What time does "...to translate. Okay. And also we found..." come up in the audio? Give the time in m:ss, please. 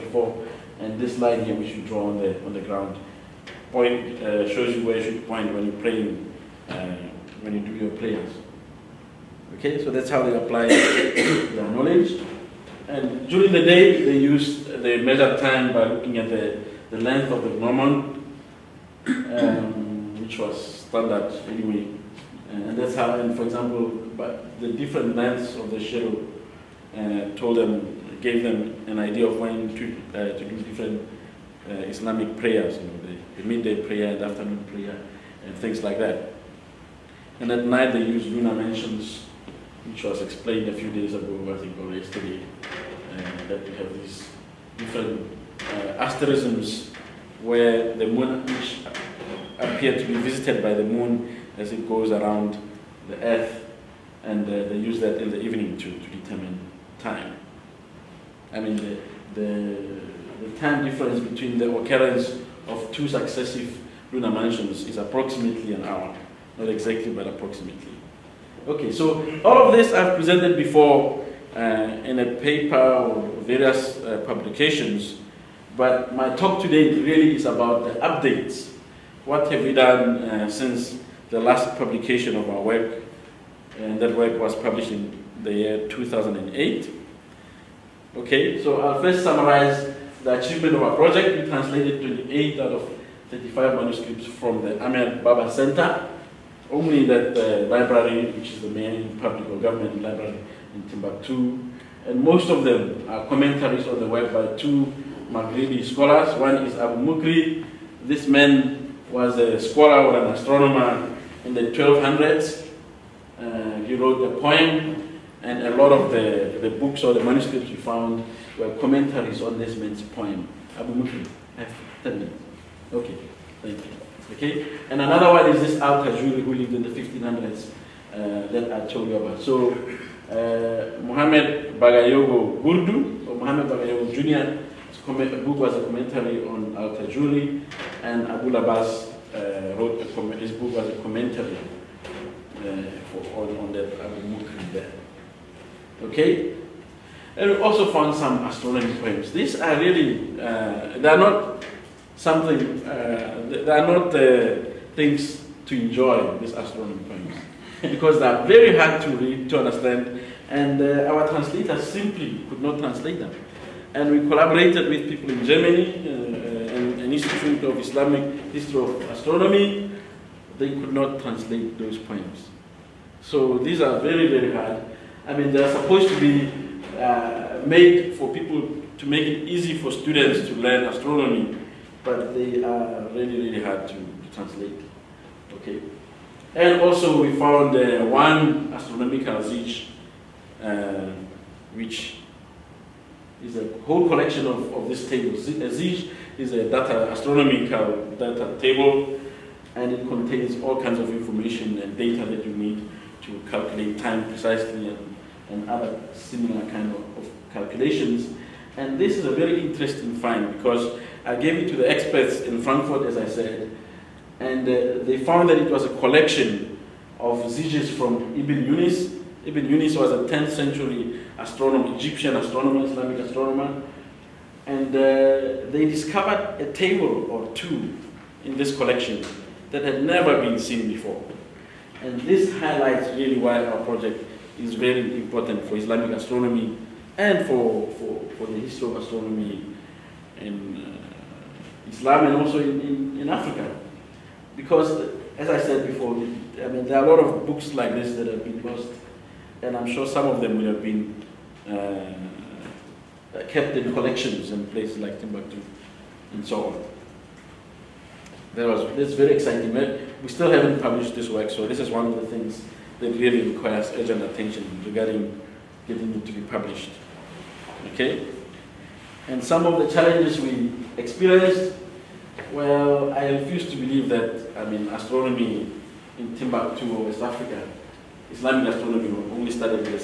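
3:03.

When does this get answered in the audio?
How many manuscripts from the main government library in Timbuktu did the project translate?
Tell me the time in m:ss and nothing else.
1:31.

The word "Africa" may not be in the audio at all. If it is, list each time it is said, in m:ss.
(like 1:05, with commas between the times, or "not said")
4:03, 4:37.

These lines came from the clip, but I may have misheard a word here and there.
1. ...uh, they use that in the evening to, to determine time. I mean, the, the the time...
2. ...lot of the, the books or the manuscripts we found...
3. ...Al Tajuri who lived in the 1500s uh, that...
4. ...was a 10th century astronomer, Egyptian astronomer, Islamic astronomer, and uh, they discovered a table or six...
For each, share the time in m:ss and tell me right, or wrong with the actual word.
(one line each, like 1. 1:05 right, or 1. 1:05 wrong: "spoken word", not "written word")
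1. 0:54 right
2. 1:55 right
3. 2:05 right
4. 3:39 wrong: "two", not "six".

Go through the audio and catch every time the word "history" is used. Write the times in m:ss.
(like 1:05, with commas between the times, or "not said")
2:48, 3:58.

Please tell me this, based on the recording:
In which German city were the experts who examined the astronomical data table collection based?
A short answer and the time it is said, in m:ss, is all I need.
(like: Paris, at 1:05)
Frankfurt, at 3:32.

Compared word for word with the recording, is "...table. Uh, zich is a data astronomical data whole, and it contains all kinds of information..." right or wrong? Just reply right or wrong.
wrong.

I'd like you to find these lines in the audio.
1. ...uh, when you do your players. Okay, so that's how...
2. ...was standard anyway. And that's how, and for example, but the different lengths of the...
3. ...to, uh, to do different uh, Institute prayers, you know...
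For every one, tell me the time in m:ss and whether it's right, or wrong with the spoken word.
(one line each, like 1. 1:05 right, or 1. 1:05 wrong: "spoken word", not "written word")
1. 0:06 right
2. 0:20 right
3. 0:29 wrong: "Islamic", not "Institute".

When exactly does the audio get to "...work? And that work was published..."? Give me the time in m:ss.
1:22.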